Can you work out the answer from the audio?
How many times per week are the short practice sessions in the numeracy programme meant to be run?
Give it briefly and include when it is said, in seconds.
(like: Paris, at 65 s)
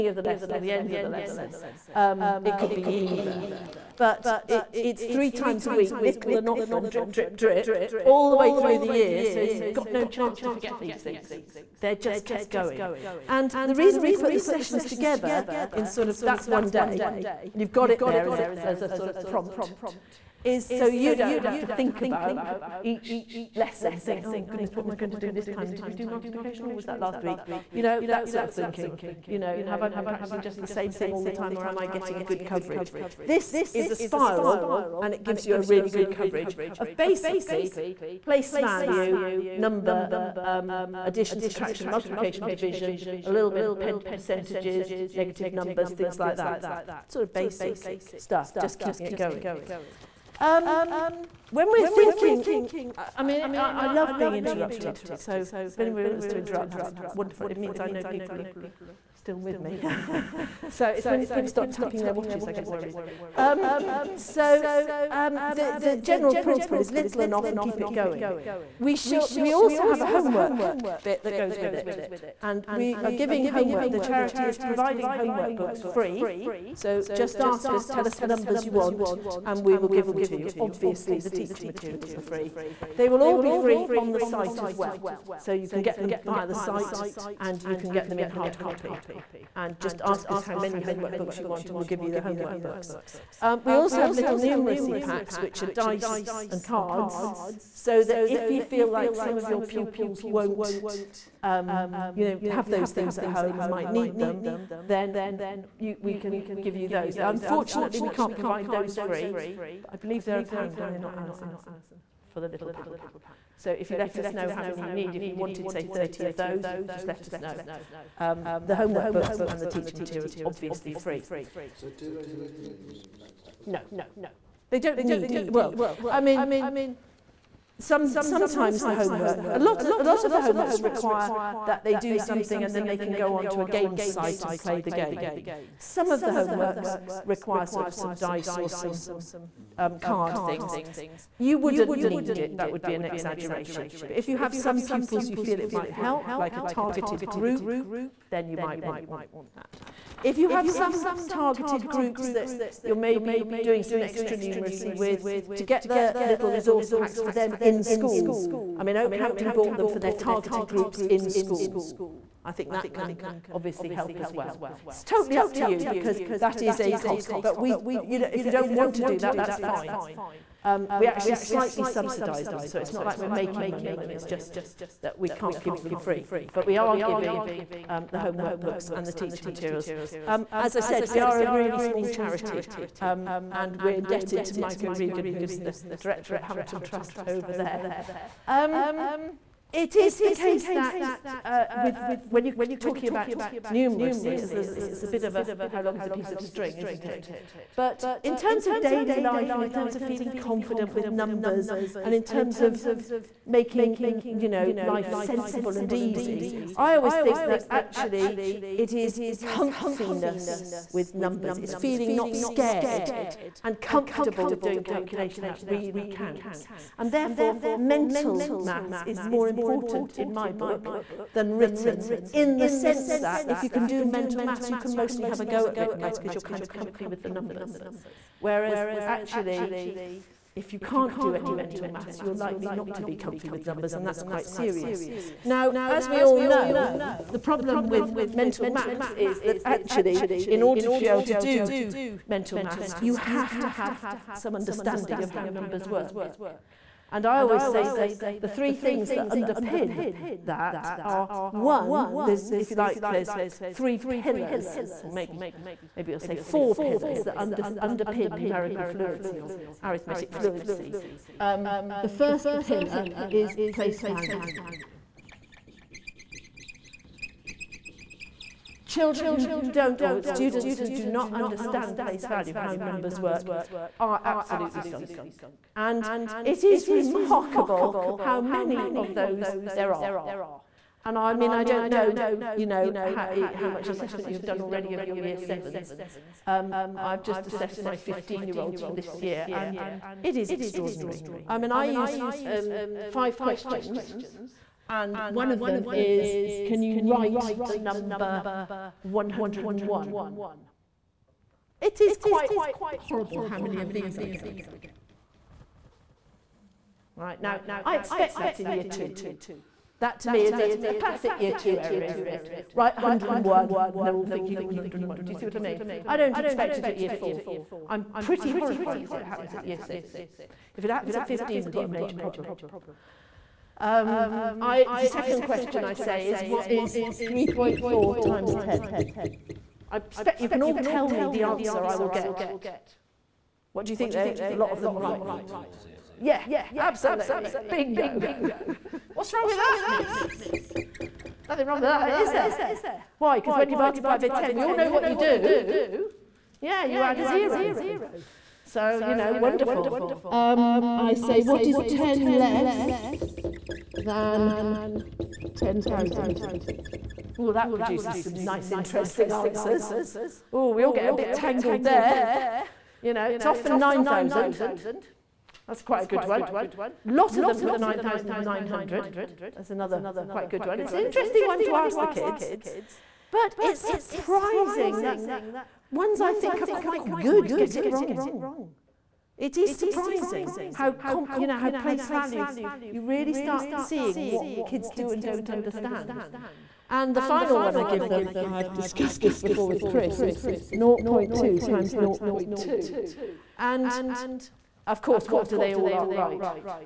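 3 times a week, at 5 s.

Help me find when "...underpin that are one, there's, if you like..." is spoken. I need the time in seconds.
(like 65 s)
249 s.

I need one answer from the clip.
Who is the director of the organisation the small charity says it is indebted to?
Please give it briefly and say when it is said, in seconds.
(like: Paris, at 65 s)
Mike O'Regan, at 184 s.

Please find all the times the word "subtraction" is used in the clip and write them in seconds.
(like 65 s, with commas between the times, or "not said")
41 s.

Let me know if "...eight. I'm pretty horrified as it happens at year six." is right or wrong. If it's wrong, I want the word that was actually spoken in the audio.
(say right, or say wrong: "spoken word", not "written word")
wrong: "four", not "eight".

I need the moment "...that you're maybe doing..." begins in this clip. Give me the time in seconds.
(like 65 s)
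152 s.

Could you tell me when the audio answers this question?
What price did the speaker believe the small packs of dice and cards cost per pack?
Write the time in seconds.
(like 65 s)
110 s.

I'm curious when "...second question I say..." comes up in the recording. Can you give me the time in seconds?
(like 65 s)
325 s.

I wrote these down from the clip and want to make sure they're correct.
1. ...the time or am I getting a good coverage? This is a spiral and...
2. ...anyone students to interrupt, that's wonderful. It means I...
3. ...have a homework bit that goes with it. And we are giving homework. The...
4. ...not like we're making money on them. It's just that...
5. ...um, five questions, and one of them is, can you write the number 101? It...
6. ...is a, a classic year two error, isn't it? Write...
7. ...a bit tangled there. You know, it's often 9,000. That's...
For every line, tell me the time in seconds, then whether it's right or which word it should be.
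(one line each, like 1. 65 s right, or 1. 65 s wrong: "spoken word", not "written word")
1. 31 s right
2. 55 s wrong: "wants", not "students"
3. 69 s right
4. 172 s right
5. 292 s right
6. 310 s right
7. 361 s right.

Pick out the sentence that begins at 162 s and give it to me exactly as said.
I think that can obviously help as well.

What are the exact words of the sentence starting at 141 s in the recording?
You wouldn't need it, that would be an exaggeration.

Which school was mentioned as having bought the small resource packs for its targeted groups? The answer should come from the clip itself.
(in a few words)
Okehampton.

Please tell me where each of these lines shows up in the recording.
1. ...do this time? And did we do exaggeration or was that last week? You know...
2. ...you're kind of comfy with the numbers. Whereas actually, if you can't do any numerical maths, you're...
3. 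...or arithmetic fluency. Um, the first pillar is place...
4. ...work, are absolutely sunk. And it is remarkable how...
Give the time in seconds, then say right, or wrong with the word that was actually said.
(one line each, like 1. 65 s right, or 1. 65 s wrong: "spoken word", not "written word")
1. 25 s wrong: "multiplication", not "exaggeration"
2. 226 s wrong: "mental", not "numerical"
3. 259 s right
4. 273 s right.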